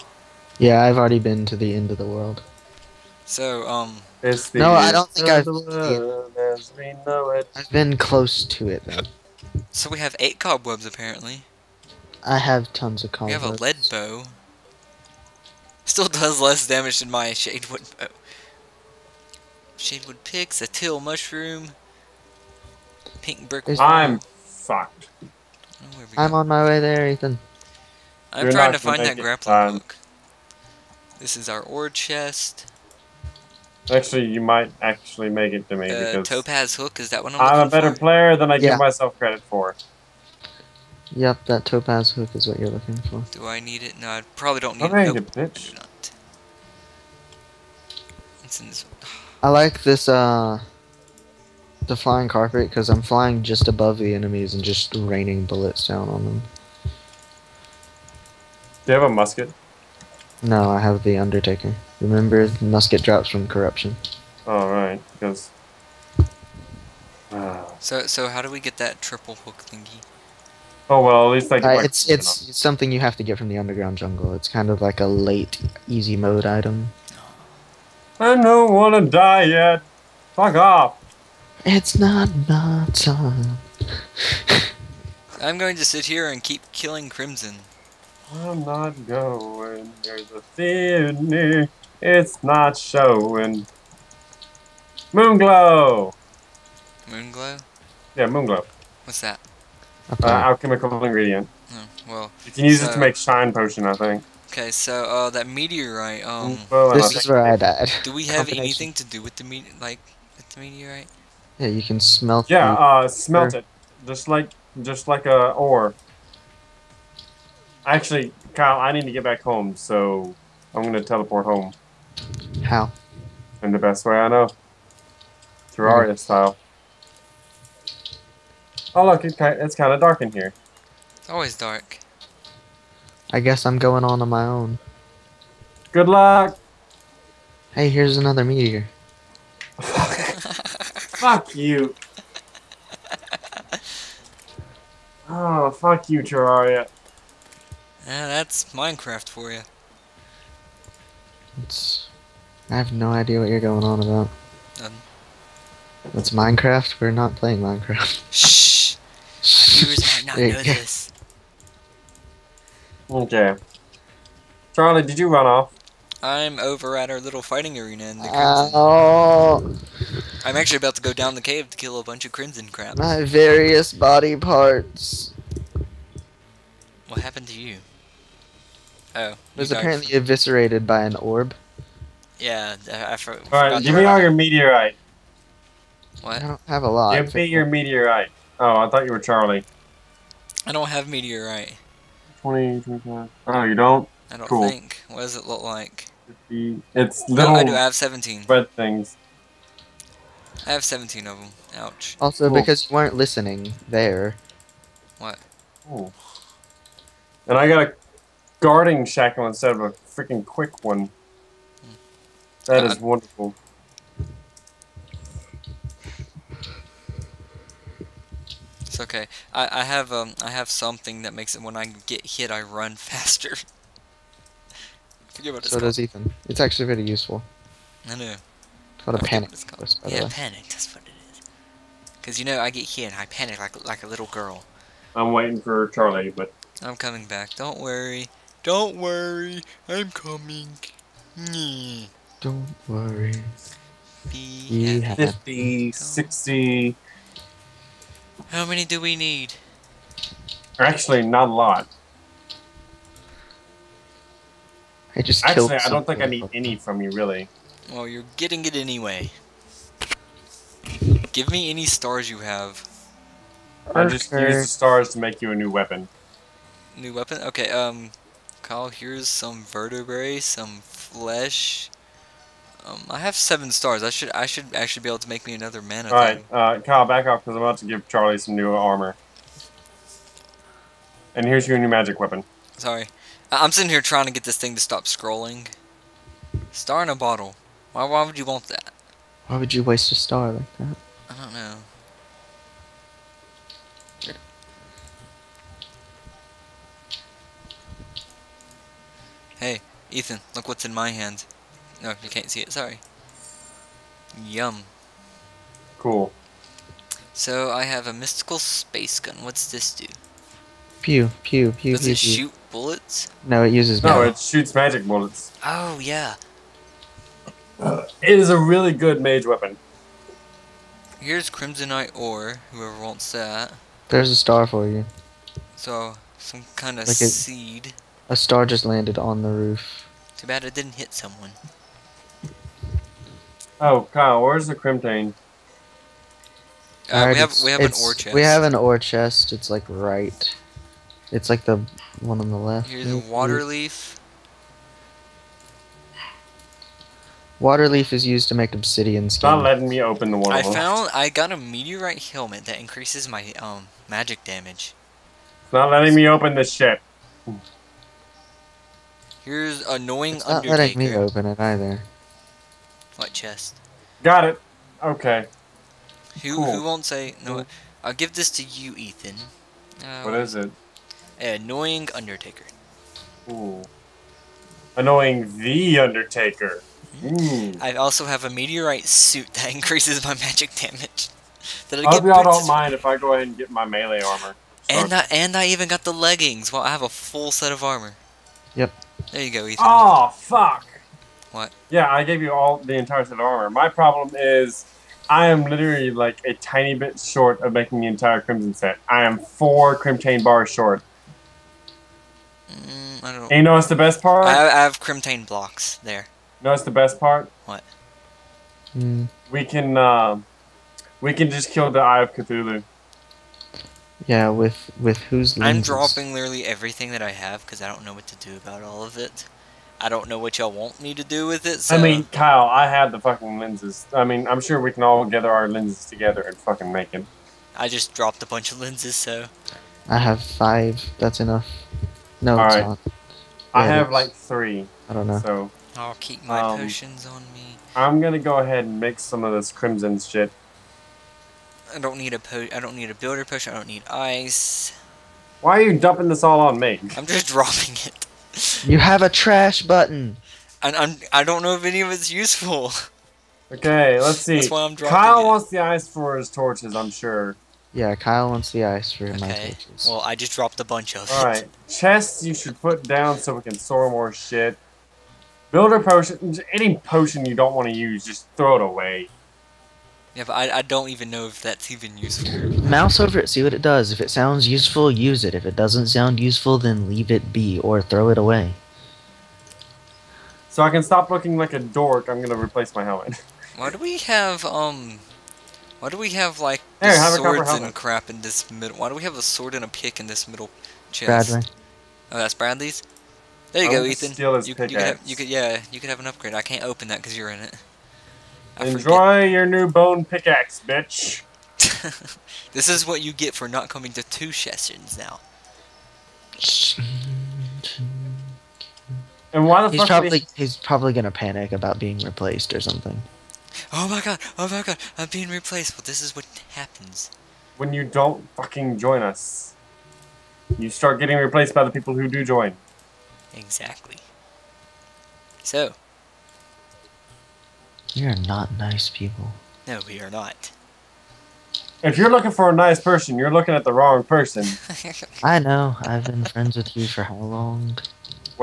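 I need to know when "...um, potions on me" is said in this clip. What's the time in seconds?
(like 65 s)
436 s.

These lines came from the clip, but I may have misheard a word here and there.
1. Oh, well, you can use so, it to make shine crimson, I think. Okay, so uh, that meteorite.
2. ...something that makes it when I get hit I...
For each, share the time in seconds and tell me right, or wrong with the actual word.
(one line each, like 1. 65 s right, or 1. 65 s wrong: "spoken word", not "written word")
1. 101 s wrong: "potion", not "crimson"
2. 220 s right.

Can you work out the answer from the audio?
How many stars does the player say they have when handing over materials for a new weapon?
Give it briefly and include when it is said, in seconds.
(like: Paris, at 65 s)
7, at 273 s.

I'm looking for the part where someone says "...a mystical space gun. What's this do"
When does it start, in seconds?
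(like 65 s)
308 s.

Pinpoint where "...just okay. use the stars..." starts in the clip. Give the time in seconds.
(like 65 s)
264 s.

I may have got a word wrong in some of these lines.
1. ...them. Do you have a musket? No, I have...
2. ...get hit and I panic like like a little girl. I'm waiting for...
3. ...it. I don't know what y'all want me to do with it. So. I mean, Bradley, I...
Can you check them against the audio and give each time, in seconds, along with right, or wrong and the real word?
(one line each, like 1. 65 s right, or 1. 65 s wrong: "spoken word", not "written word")
1. 56 s right
2. 232 s right
3. 419 s wrong: "Kyle", not "Bradley".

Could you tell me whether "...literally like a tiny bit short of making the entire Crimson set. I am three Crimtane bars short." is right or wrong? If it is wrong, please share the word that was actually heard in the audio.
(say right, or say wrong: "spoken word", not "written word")
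wrong: "four", not "three".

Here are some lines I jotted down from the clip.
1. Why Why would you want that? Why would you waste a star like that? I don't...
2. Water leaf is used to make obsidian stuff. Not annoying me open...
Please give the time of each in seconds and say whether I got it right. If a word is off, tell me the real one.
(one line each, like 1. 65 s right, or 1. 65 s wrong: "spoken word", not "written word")
1. 287 s right
2. 347 s wrong: "letting", not "annoying".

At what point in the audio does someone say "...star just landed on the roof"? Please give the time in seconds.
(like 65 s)
328 s.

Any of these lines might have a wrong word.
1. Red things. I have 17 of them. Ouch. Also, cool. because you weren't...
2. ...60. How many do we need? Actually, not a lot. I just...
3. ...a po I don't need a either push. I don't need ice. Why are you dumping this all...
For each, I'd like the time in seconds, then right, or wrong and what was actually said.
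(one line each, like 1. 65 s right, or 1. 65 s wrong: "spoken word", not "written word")
1. 198 s right
2. 245 s right
3. 442 s wrong: "builder", not "either".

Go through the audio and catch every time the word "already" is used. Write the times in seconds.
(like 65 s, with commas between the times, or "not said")
0 s.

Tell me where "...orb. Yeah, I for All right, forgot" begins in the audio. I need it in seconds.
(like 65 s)
181 s.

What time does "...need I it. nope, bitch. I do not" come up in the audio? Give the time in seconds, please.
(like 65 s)
44 s.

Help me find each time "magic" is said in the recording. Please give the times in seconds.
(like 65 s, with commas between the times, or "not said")
281 s, 314 s, 354 s, 380 s.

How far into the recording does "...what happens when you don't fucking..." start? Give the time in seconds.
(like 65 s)
516 s.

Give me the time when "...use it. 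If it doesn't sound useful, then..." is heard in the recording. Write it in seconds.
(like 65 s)
475 s.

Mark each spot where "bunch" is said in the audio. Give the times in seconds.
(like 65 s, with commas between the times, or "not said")
172 s, 428 s, 460 s.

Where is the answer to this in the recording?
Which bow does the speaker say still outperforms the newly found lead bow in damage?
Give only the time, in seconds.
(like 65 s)
17 s.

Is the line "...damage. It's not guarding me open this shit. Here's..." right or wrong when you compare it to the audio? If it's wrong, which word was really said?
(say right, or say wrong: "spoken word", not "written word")
wrong: "letting", not "guarding".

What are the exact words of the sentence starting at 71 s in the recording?
Uh, it's it's, it's something you have to get from the underground jungle.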